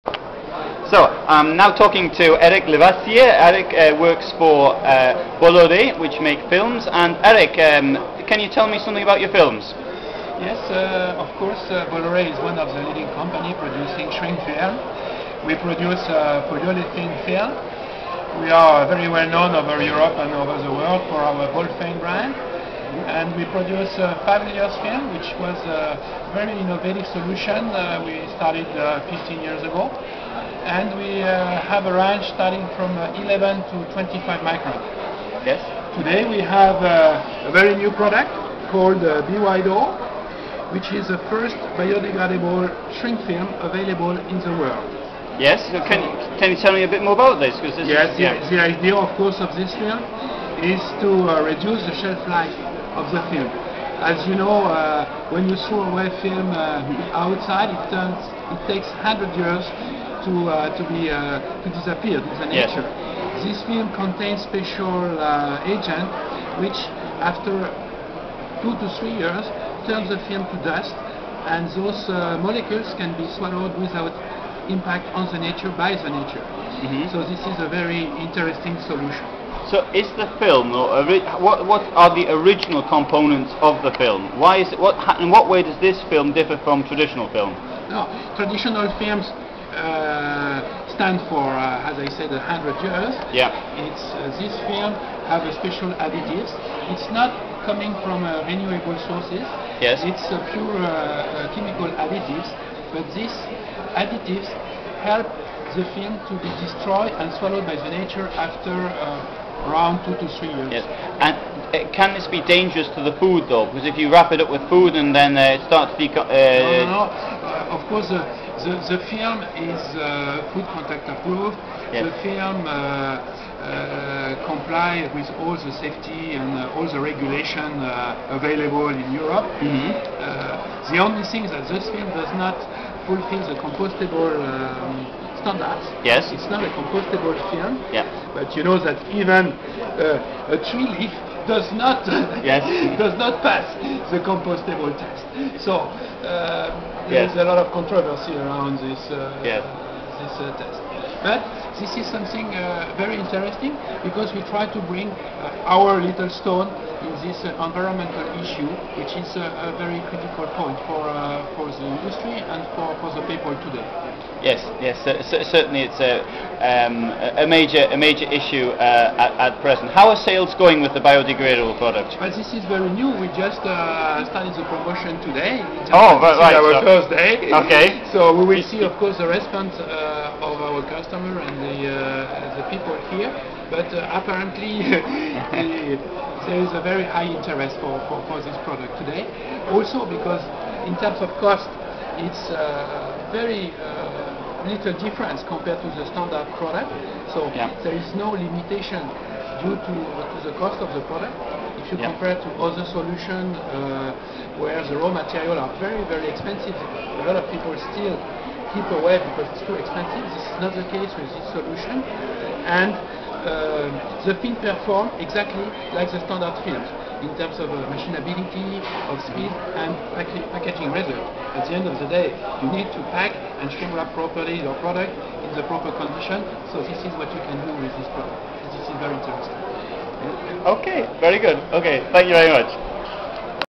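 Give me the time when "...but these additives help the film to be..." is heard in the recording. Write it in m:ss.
1:42.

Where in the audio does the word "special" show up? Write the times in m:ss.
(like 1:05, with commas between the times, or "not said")
1:04, 1:35.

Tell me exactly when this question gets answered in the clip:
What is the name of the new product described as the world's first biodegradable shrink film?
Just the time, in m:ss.
0:39.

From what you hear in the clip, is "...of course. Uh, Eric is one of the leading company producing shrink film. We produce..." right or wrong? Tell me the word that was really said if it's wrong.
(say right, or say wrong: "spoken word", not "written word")
wrong: "Bolloré", not "Eric".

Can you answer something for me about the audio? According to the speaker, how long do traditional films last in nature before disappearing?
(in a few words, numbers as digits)
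100 years.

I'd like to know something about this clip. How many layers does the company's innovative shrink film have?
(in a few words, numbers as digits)
5.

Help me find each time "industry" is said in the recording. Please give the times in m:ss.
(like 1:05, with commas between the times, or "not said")
2:41.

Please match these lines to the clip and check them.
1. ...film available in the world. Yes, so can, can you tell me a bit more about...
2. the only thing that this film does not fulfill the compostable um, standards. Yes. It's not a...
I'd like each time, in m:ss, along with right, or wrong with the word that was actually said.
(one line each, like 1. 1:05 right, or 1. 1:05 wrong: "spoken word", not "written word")
1. 0:43 right
2. 2:10 right.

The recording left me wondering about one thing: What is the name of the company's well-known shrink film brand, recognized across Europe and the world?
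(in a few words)
Bolphane.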